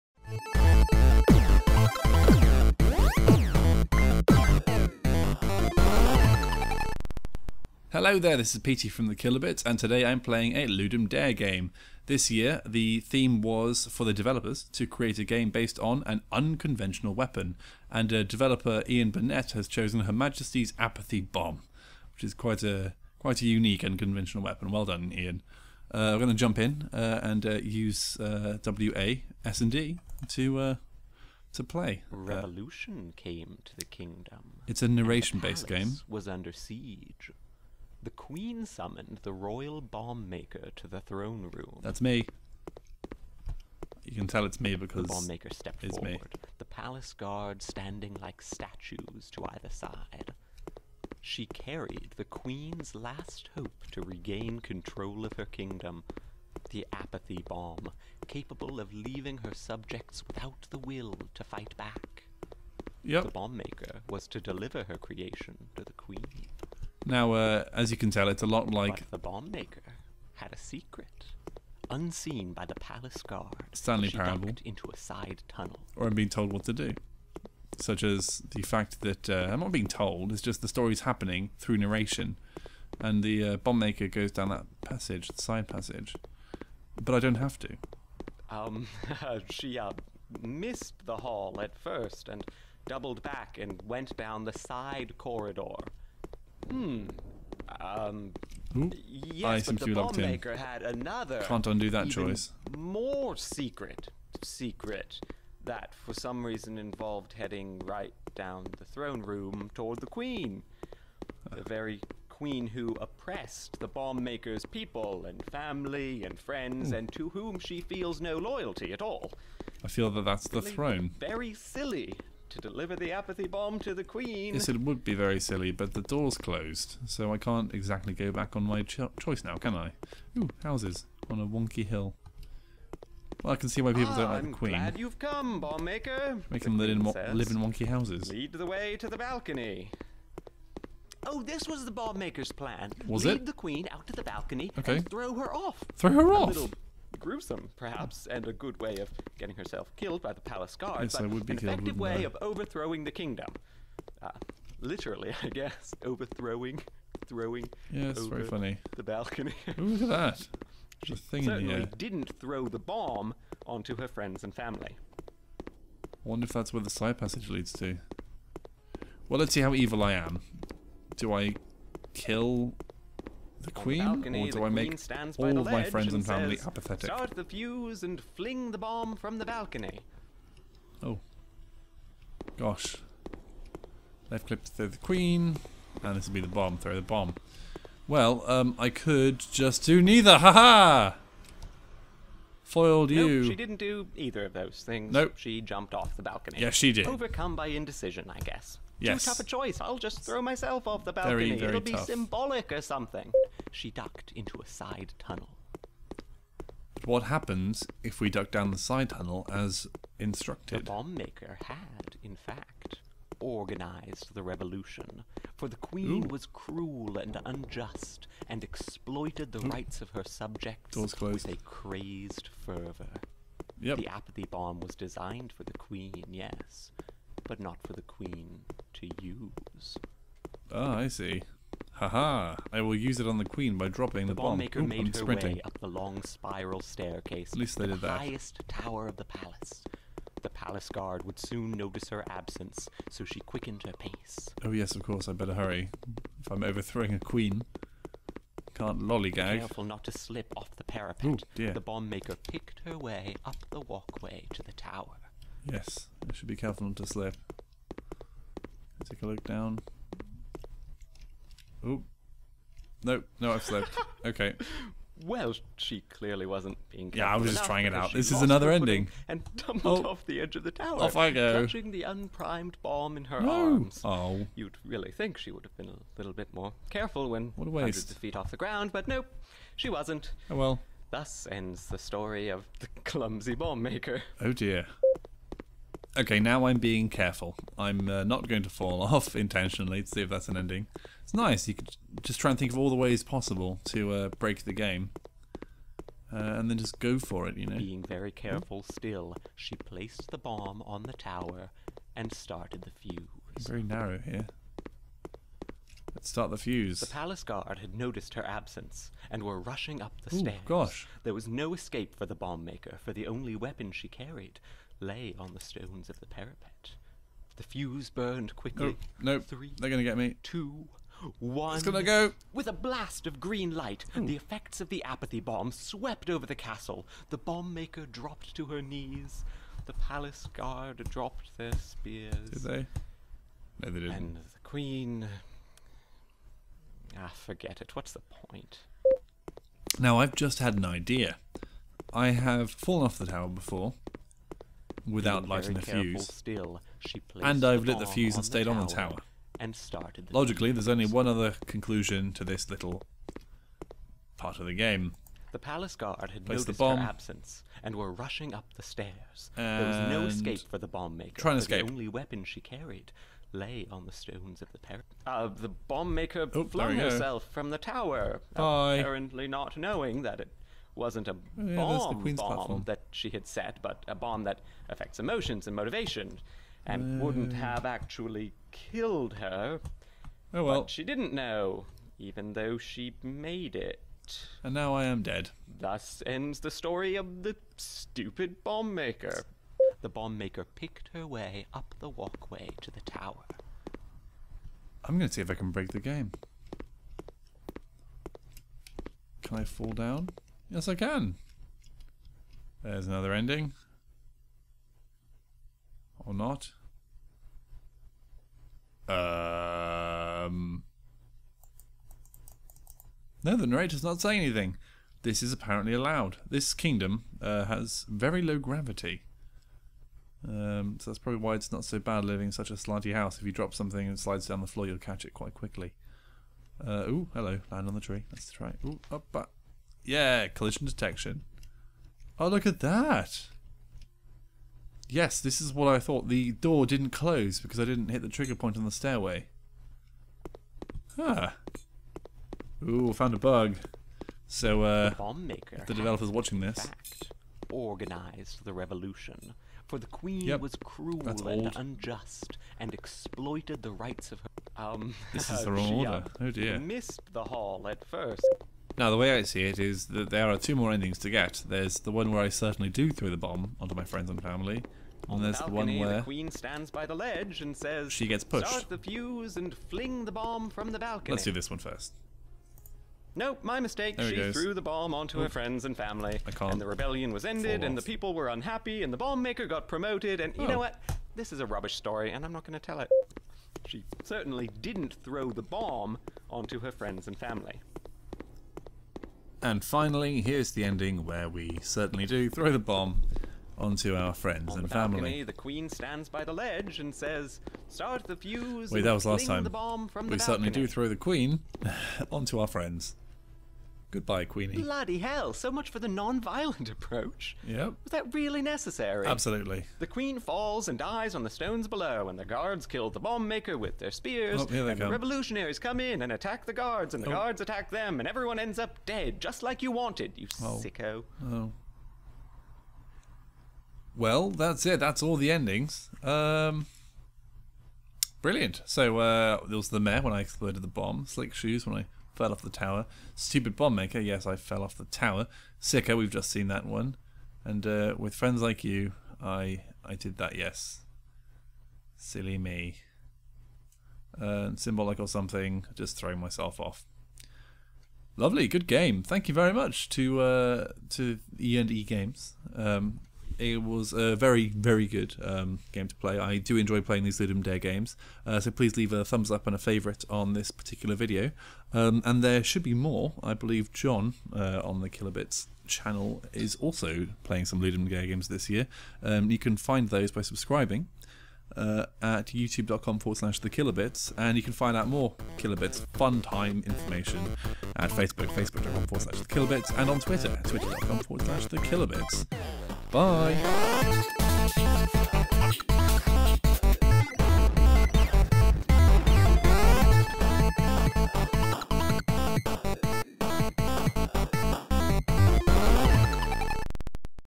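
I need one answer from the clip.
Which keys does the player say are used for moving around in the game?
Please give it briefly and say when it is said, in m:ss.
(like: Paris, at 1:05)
W A S and D, at 0:28.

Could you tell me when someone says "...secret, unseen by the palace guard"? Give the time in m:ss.
1:10.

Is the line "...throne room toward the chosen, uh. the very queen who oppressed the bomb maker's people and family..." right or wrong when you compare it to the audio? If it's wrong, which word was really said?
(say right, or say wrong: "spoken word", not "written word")
wrong: "queen", not "chosen".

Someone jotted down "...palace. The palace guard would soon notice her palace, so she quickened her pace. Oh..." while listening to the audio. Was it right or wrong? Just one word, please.
wrong.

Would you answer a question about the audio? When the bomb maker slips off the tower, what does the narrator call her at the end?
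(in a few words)
The clumsy bomb maker.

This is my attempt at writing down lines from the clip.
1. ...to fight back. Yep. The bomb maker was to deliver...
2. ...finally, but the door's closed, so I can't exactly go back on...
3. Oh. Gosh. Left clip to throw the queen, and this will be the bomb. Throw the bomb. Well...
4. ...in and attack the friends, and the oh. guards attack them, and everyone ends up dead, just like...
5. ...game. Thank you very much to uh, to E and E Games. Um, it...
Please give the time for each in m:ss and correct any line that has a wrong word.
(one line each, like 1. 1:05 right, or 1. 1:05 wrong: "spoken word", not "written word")
1. 1:01 right
2. 2:05 wrong: "silly", not "finally"
3. 3:01 right
4. 8:36 wrong: "guards", not "friends"
5. 9:08 right.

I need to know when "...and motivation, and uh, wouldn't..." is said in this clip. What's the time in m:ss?
6:15.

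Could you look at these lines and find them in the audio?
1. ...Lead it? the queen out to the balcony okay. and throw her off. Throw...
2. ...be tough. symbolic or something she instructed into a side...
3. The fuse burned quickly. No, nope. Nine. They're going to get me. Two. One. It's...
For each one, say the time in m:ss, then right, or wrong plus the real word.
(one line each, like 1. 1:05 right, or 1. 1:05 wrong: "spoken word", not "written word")
1. 2:23 right
2. 3:21 wrong: "ducked", not "instructed"
3. 5:17 wrong: "Three", not "Nine".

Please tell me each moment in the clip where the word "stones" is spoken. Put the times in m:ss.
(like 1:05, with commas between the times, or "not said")
5:15, 6:04, 8:31.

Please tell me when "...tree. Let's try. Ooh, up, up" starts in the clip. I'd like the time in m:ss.
7:07.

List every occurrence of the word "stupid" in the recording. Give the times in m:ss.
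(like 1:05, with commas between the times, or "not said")
6:27, 8:53.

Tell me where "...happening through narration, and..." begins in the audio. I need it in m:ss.
1:21.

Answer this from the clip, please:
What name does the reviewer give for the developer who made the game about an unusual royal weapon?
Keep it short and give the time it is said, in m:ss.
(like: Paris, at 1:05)
Ian Burnette, at 0:18.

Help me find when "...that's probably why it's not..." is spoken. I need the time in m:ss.
7:01.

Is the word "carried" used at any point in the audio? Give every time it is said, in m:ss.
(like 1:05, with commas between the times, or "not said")
0:51, 5:14, 6:02.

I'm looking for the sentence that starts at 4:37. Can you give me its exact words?
hundreds of feet off the ground, but nope, she wasn't.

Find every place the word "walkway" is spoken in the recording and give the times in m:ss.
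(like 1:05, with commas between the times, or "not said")
4:13, 6:32.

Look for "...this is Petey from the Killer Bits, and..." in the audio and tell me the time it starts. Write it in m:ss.
0:08.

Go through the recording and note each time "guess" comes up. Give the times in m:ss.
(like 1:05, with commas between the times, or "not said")
2:35, 3:18.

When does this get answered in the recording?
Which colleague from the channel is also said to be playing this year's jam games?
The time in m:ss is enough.
9:23.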